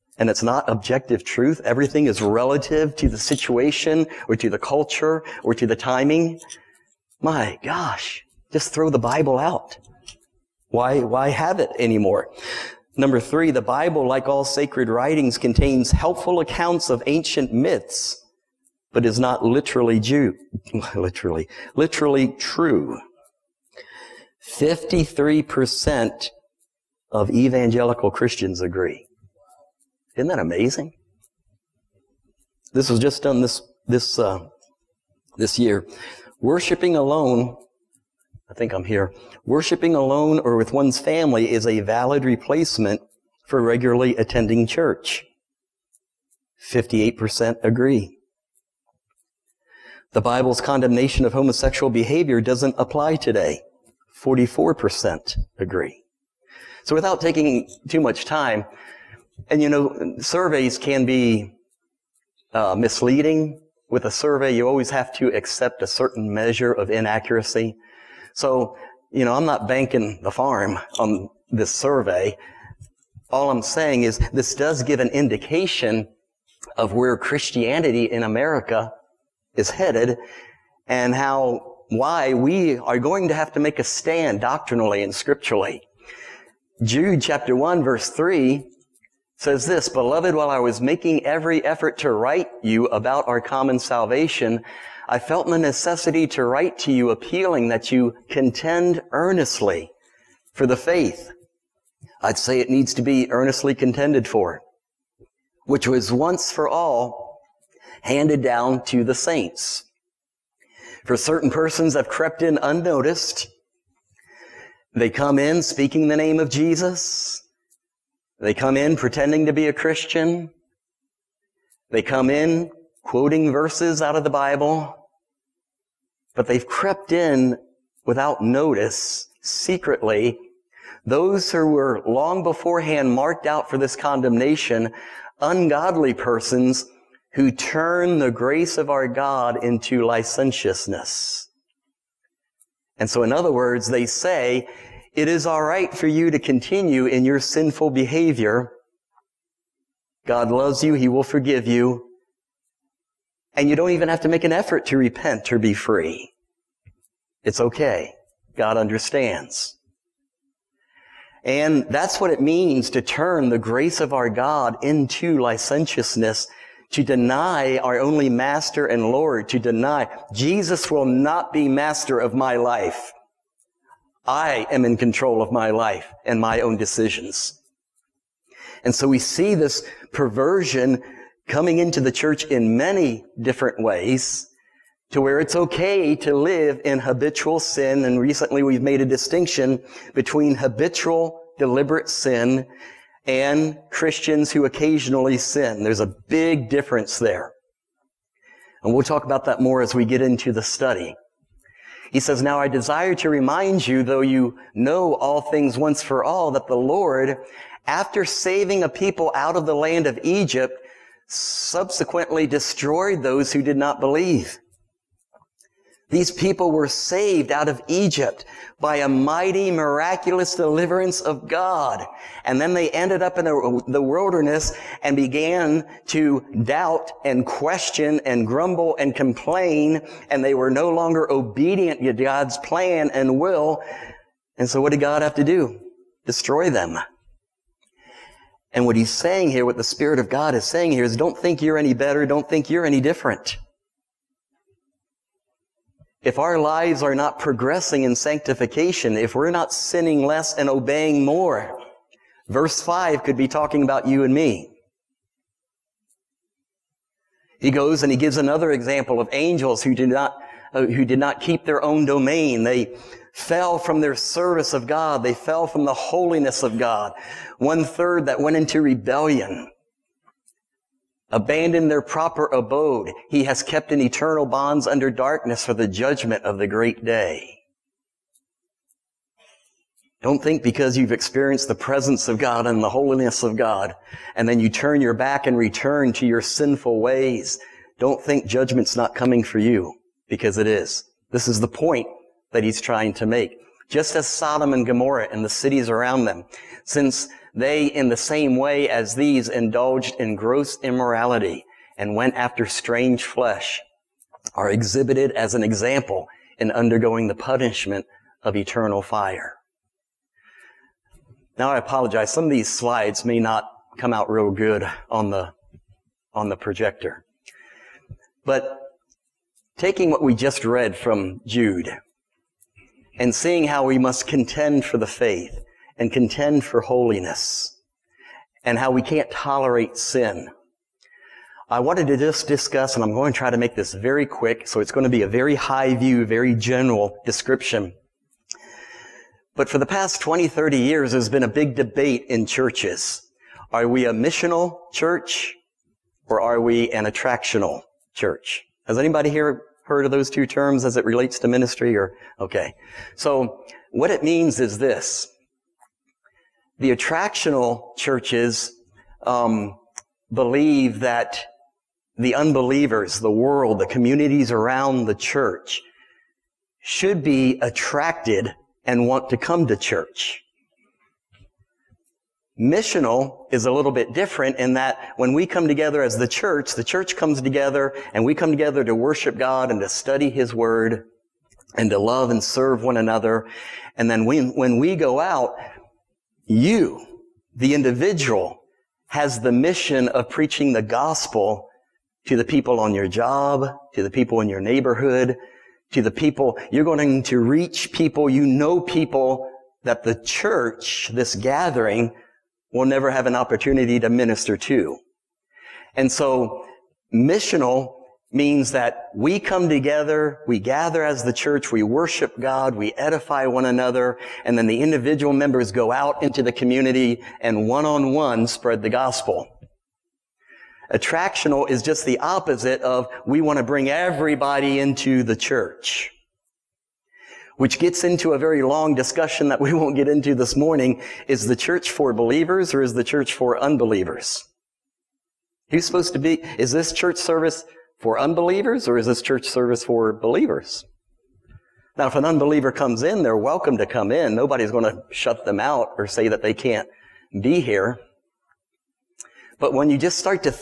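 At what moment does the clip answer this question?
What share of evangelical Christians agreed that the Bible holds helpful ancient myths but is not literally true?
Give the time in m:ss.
0:24.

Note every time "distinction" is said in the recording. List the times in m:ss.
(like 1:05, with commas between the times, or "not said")
3:09.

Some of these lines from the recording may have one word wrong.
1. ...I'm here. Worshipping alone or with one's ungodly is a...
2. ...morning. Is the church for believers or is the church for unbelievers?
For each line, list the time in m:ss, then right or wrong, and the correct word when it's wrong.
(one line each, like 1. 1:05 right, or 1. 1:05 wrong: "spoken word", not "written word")
1. 0:38 wrong: "family", not "ungodly"
2. 7:10 right.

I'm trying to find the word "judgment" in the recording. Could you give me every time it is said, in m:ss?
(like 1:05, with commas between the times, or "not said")
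4:35, 4:48.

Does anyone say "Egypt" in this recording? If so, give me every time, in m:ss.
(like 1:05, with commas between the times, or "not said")
3:30, 3:37.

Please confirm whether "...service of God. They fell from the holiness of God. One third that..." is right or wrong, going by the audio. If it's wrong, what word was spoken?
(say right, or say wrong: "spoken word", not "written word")
right.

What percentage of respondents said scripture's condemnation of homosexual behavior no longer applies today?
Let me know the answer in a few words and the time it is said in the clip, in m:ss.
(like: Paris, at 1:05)
44%, at 0:54.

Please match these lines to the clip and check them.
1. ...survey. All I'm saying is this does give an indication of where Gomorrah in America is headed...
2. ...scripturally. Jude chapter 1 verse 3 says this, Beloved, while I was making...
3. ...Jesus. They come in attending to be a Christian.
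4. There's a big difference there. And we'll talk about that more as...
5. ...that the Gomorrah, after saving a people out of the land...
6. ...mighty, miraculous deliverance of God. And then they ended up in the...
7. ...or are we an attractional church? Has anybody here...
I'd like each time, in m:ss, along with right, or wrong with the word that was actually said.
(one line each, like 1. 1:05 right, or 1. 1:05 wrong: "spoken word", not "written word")
1. 1:11 wrong: "Christianity", not "Gomorrah"
2. 1:25 right
3. 1:56 wrong: "pretending", not "attending"
4. 3:15 right
5. 3:26 wrong: "Lord", not "Gomorrah"
6. 3:39 right
7. 5:46 right.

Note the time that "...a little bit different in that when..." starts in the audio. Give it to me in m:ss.
6:13.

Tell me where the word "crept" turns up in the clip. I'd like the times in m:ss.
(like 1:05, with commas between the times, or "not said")
1:52, 2:06.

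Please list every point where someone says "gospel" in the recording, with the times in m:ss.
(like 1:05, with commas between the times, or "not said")
6:30, 6:58.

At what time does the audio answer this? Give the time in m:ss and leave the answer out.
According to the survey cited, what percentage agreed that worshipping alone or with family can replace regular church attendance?
0:46.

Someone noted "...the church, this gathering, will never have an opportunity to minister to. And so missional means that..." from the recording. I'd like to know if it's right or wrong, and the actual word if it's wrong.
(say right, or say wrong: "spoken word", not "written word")
right.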